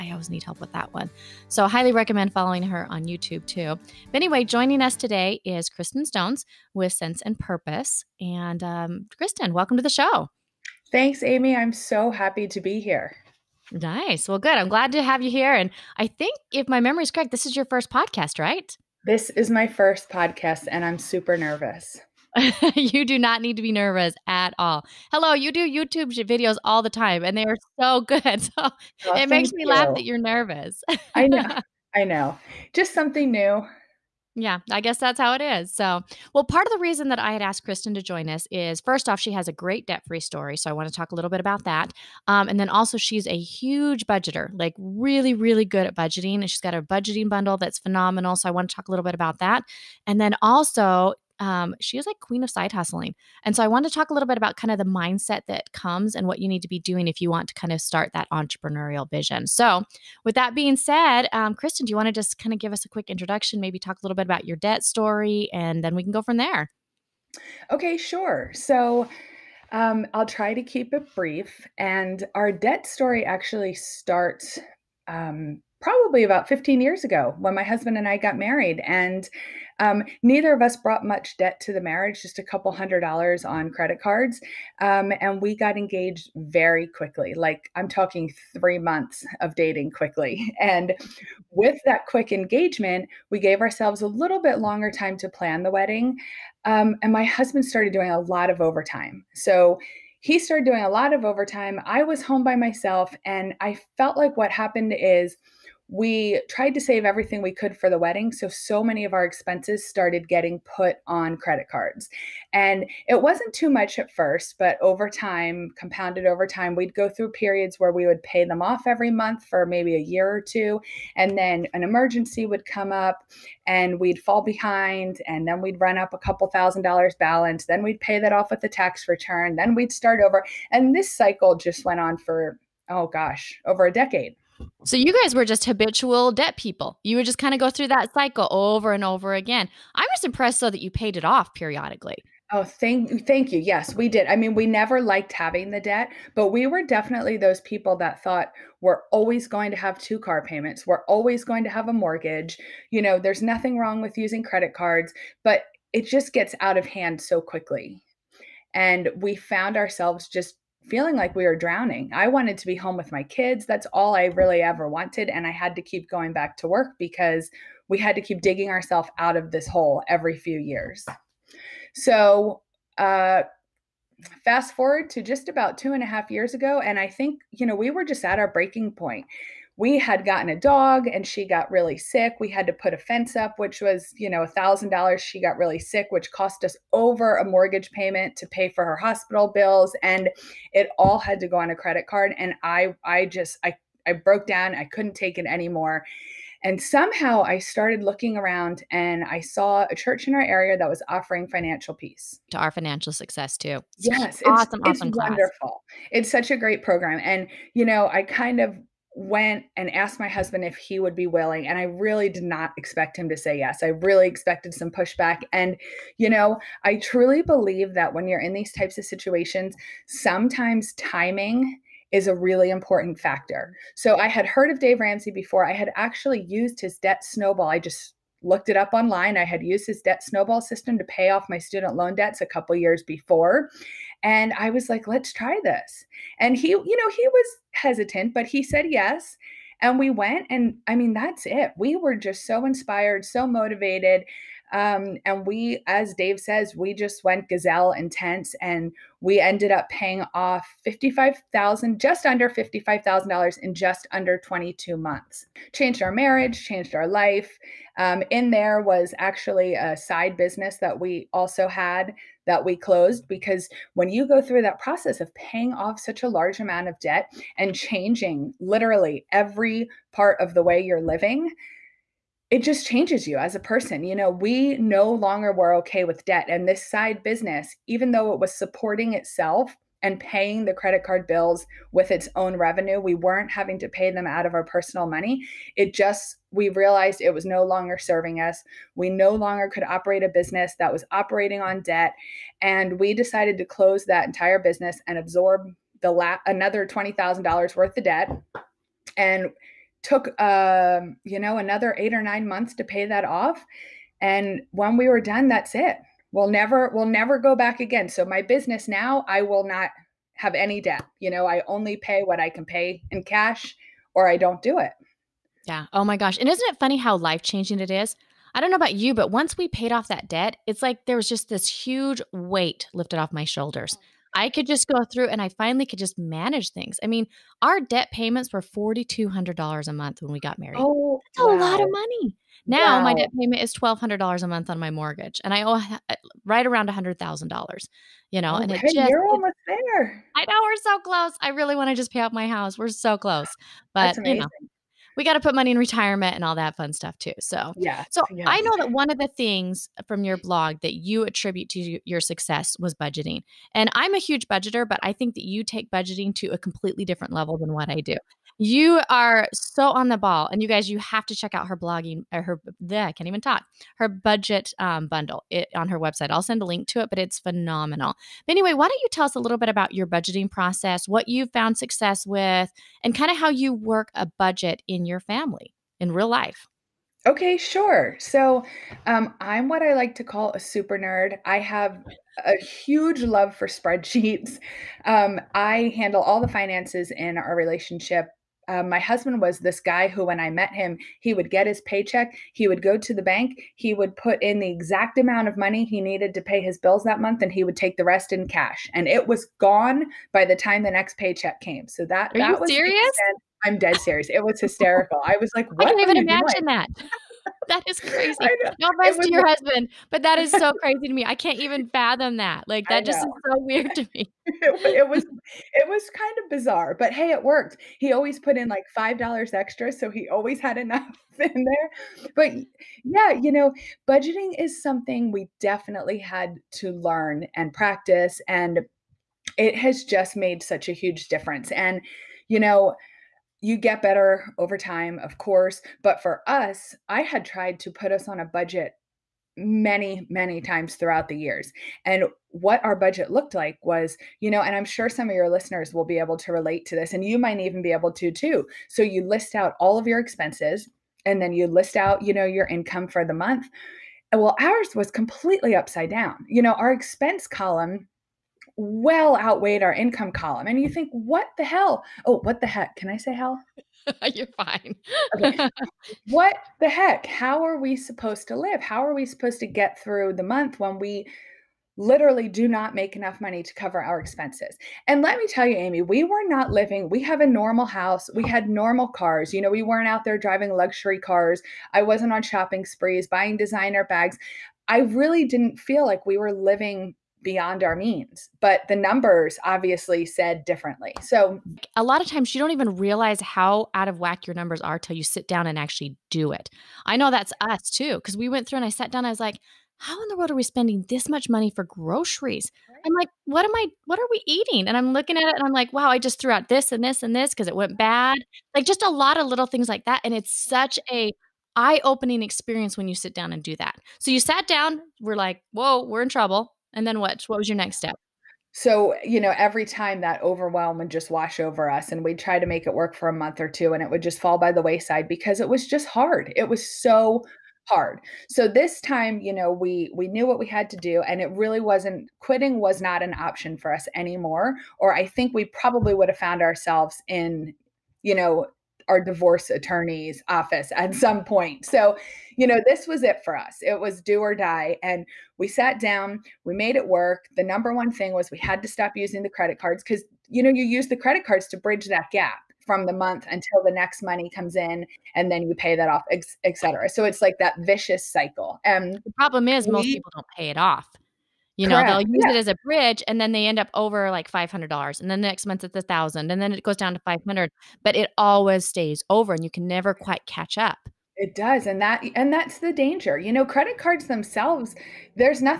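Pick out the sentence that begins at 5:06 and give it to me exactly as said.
We'll never, we'll never go back again.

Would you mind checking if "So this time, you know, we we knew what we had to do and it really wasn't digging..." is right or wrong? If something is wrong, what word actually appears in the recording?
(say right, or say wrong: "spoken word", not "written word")
wrong: "quitting", not "digging".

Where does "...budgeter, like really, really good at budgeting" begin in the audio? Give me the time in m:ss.
0:44.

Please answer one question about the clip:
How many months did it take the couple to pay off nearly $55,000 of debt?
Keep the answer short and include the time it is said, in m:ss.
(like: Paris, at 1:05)
22 months, at 4:14.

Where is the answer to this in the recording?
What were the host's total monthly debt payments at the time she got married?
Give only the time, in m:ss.
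5:28.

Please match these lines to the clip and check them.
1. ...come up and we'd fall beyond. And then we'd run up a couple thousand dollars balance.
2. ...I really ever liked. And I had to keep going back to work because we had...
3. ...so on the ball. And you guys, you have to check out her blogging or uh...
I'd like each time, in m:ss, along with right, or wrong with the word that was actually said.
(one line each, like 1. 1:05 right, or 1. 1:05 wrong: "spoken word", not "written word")
1. 2:02 wrong: "behind", not "beyond"
2. 2:44 wrong: "wanted", not "liked"
3. 5:59 right.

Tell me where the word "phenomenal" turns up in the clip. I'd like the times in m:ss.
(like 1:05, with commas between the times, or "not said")
0:47, 6:07.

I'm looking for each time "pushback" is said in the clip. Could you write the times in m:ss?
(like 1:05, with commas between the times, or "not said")
3:34.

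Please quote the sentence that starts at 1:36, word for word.
Um, and my husband started doing a lot of overtime.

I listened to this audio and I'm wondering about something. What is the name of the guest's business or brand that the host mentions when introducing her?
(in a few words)
Cents and Purpose.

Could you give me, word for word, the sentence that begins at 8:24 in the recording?
And I'm looking at it and I'm like, wow, I just threw out this and this and this because it went bad.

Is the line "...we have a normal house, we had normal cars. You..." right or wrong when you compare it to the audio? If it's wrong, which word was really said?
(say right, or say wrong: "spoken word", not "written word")
right.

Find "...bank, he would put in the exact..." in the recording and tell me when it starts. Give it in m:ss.
6:33.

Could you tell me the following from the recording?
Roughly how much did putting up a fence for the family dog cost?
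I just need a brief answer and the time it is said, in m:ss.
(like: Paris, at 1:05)
$1,000, at 3:04.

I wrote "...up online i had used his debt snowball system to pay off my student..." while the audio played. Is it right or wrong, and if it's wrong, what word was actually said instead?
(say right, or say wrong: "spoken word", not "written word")
right.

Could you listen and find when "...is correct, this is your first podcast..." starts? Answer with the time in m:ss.
0:17.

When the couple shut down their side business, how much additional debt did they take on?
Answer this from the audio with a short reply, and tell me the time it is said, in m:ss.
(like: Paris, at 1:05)
$20,000, at 4:56.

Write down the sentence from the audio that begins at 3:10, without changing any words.
And it all had to go on a credit card.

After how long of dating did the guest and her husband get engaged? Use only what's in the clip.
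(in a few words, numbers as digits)
3 months.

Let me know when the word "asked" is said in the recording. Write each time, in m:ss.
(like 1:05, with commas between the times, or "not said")
0:37, 3:29.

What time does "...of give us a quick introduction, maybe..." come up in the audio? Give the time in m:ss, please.
1:02.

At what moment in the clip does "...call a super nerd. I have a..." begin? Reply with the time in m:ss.
6:20.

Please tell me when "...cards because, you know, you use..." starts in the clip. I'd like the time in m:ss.
9:09.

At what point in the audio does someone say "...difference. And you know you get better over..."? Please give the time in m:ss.
7:11.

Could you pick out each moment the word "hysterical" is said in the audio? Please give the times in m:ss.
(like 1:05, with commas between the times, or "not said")
6:44.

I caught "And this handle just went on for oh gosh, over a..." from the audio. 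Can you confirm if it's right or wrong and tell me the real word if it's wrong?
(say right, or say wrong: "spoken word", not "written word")
wrong: "cycle", not "handle".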